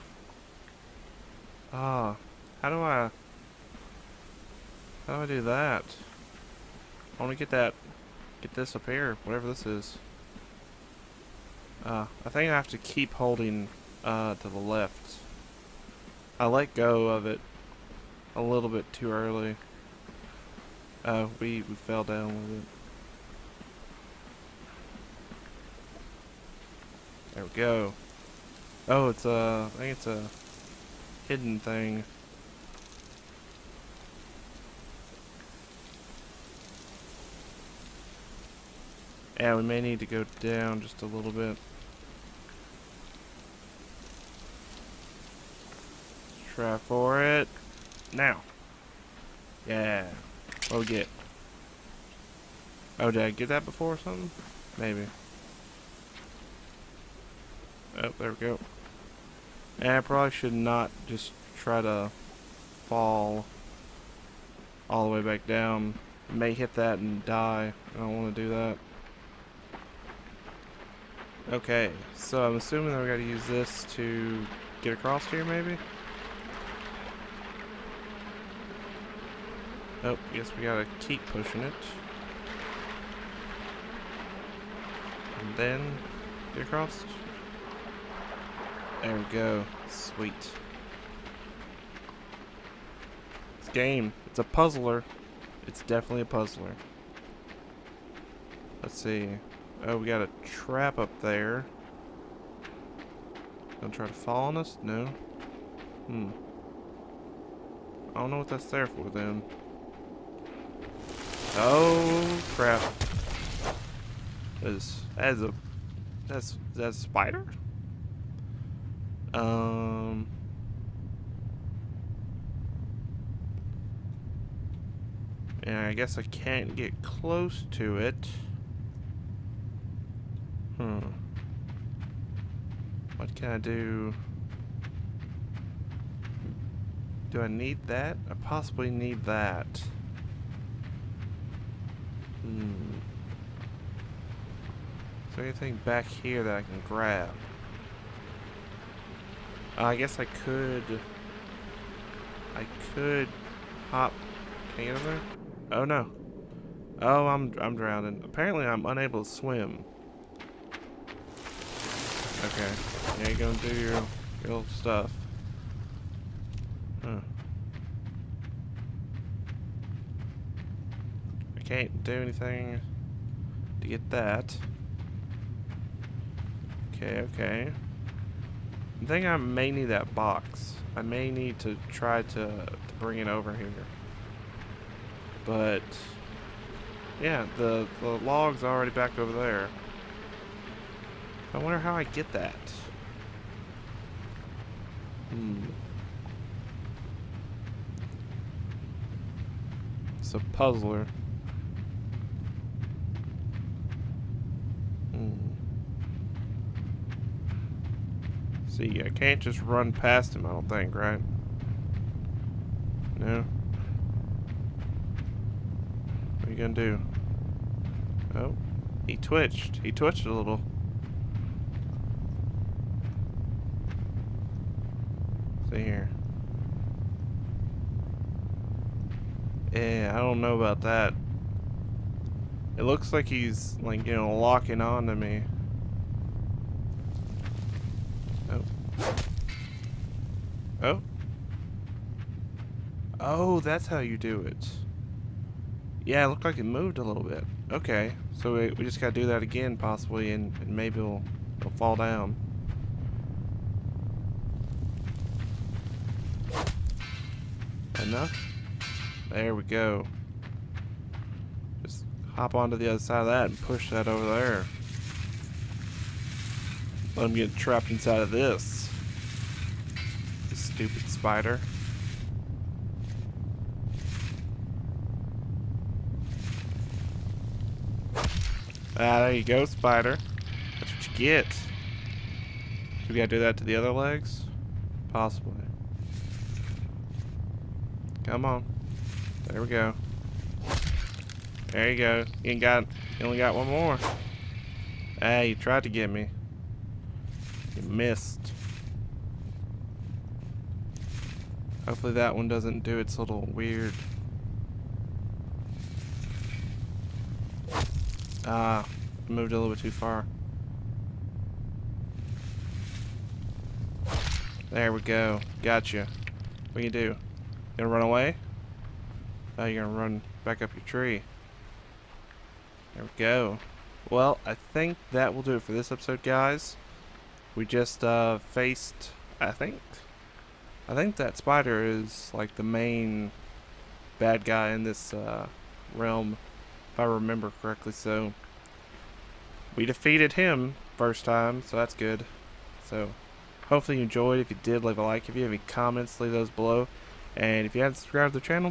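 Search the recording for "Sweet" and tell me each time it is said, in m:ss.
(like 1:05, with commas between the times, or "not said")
1:29.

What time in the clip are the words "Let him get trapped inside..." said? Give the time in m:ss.
4:27.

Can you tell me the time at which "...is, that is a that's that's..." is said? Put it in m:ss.
1:54.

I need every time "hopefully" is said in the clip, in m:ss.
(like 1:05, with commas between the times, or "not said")
5:01, 5:43.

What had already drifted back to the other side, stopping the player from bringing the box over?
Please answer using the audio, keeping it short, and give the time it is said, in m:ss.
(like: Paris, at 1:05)
The log, at 3:08.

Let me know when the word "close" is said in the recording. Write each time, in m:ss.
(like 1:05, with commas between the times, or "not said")
2:07.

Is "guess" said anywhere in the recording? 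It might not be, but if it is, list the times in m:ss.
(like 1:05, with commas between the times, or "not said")
2:05, 2:29.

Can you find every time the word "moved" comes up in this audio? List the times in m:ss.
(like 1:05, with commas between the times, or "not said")
4:06, 5:09.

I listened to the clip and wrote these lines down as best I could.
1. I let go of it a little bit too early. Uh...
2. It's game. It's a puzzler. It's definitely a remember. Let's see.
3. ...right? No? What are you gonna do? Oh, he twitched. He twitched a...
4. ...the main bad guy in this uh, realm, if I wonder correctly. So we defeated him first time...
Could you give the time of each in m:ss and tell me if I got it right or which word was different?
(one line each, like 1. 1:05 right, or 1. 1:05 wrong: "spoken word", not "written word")
1. 0:16 right
2. 1:33 wrong: "puzzler", not "remember"
3. 3:30 right
4. 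5:32 wrong: "remember", not "wonder".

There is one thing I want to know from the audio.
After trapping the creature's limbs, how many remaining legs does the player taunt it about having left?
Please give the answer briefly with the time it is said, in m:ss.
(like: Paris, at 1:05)
1, at 4:53.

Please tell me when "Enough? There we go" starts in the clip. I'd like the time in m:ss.
4:18.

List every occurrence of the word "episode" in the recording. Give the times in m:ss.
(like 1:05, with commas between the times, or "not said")
5:25.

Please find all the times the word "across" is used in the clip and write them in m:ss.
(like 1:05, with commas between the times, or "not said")
1:14, 1:26.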